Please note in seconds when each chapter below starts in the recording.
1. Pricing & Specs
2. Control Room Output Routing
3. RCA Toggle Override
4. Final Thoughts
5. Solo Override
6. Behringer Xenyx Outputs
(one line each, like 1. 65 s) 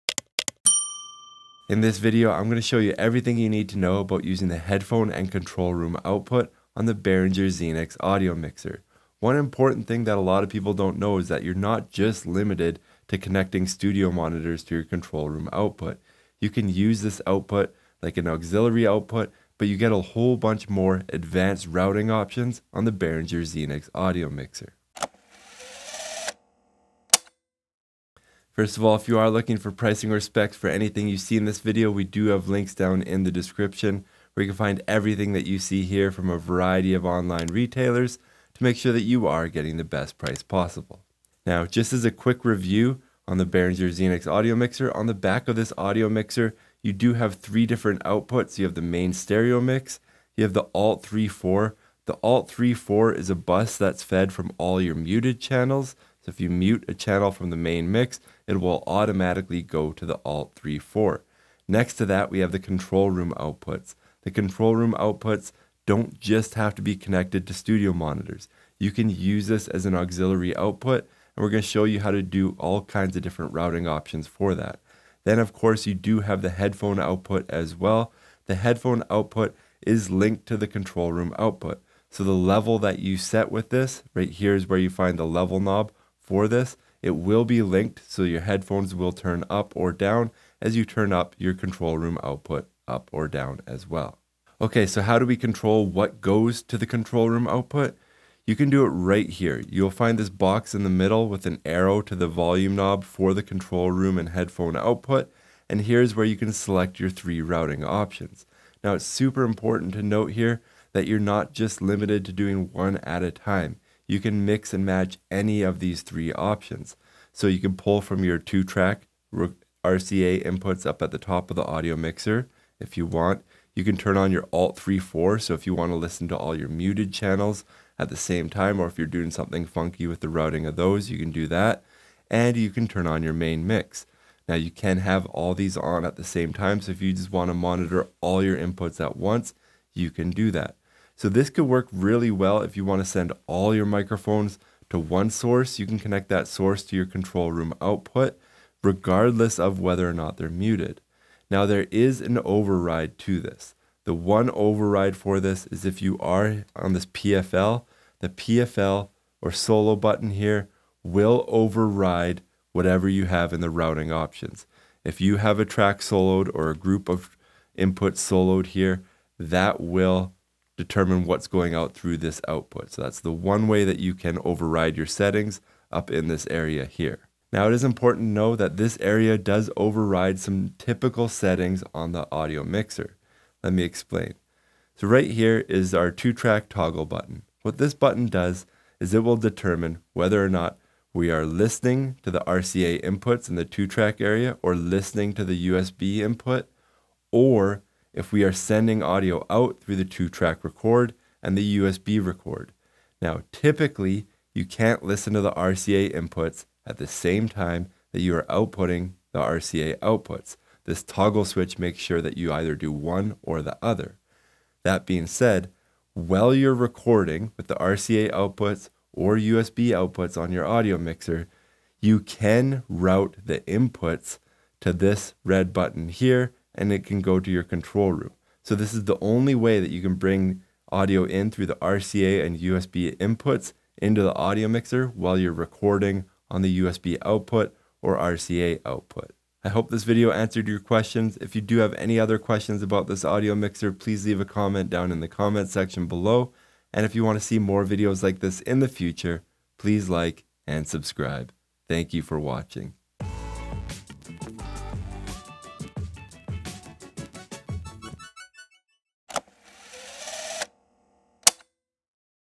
1. 28 s
2. 95 s
3. 178 s
4. 240 s
5. 152 s
6. 40 s.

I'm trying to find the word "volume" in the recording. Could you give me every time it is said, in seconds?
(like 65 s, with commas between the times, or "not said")
102 s.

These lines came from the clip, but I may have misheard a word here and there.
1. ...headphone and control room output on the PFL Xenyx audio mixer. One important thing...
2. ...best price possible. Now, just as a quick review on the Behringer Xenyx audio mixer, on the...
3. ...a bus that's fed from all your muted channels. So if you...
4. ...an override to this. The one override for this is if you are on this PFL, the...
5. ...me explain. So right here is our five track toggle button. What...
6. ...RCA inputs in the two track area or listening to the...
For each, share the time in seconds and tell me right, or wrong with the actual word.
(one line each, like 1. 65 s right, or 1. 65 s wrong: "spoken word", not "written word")
1. 4 s wrong: "Behringer", not "PFL"
2. 39 s right
3. 53 s right
4. 152 s right
5. 183 s wrong: "two", not "five"
6. 192 s right.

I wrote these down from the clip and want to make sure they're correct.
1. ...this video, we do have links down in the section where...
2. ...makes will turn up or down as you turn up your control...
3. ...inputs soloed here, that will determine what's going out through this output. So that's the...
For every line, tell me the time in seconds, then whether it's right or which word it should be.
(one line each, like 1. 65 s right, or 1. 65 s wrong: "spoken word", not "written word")
1. 31 s wrong: "description", not "section"
2. 88 s wrong: "headphones", not "makes"
3. 167 s right.